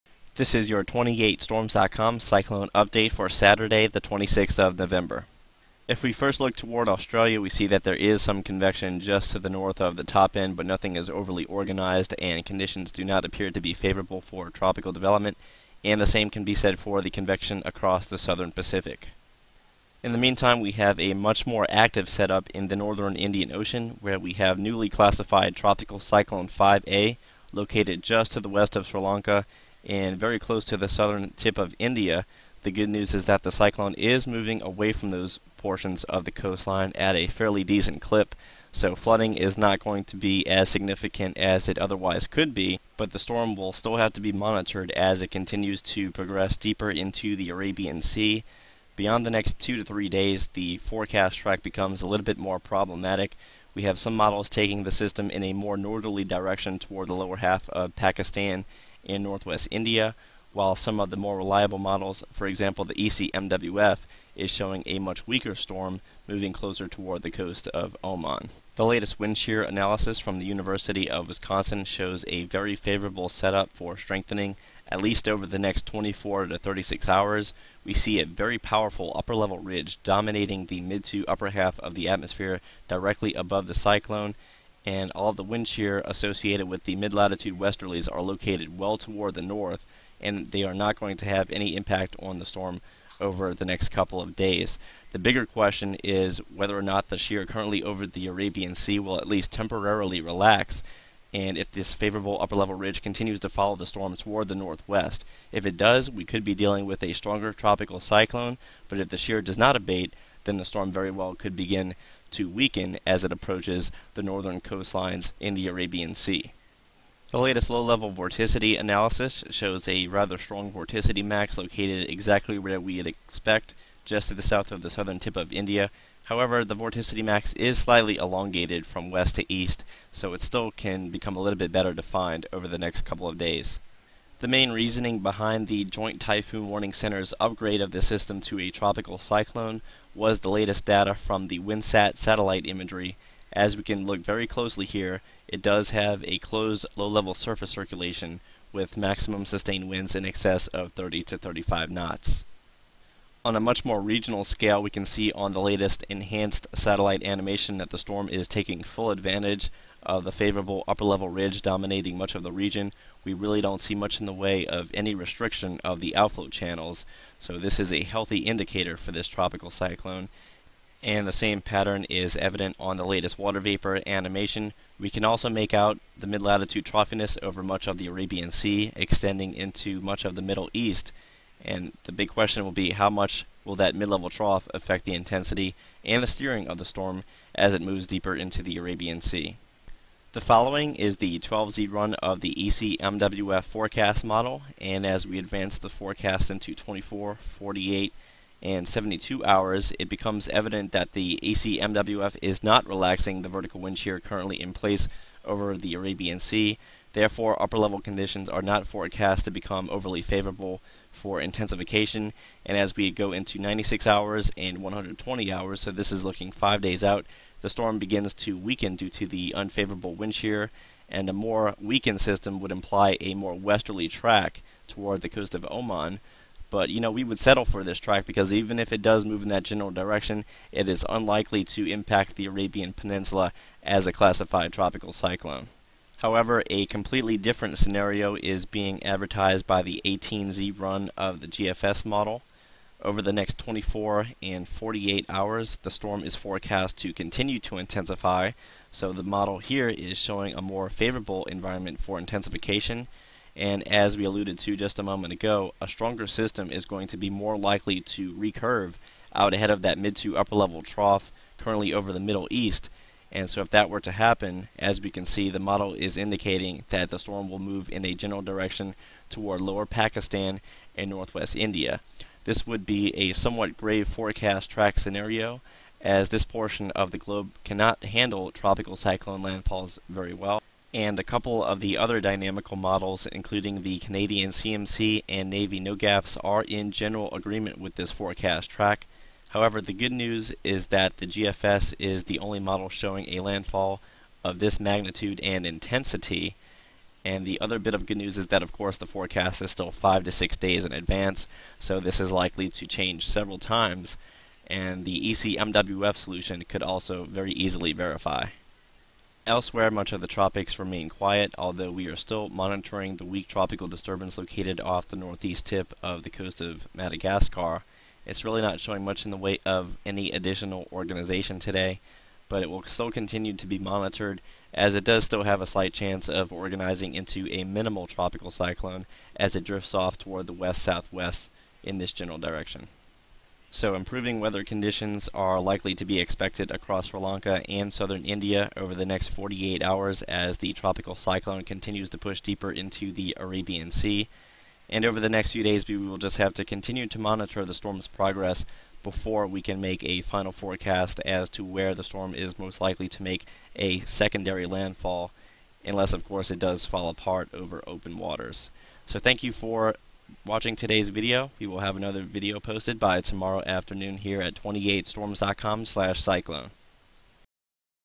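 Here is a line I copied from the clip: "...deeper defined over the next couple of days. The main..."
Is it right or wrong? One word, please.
wrong.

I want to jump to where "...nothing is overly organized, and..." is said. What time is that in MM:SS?
00:10.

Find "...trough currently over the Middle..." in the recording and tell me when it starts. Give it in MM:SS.
04:20.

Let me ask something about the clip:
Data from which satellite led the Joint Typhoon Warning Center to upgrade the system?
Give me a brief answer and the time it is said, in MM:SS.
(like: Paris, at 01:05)
WindSat, at 02:21.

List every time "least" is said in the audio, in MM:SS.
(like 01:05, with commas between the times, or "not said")
01:15, 01:39.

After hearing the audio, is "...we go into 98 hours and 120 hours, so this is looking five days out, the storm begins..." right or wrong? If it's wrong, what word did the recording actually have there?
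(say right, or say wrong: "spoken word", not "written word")
wrong: "96", not "98".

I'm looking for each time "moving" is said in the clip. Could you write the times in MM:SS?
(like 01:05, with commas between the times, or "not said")
00:34, 01:06.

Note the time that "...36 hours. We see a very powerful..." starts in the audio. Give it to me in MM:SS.
01:16.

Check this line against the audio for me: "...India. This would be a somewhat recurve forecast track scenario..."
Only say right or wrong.
wrong.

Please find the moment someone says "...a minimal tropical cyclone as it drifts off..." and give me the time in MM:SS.
05:27.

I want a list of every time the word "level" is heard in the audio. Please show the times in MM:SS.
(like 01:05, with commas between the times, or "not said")
01:19, 01:42, 01:57, 02:26, 02:41, 03:04, 03:27, 04:20.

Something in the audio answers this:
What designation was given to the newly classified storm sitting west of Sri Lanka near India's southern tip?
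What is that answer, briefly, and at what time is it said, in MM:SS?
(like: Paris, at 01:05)
Tropical Cyclone 5A, at 00:25.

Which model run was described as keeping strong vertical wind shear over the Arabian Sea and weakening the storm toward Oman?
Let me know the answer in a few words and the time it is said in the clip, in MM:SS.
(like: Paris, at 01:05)
12Z ECMWF, at 03:11.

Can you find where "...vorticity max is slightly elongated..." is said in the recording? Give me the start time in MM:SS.
02:06.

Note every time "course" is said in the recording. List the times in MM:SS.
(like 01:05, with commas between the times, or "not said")
04:58, 05:56.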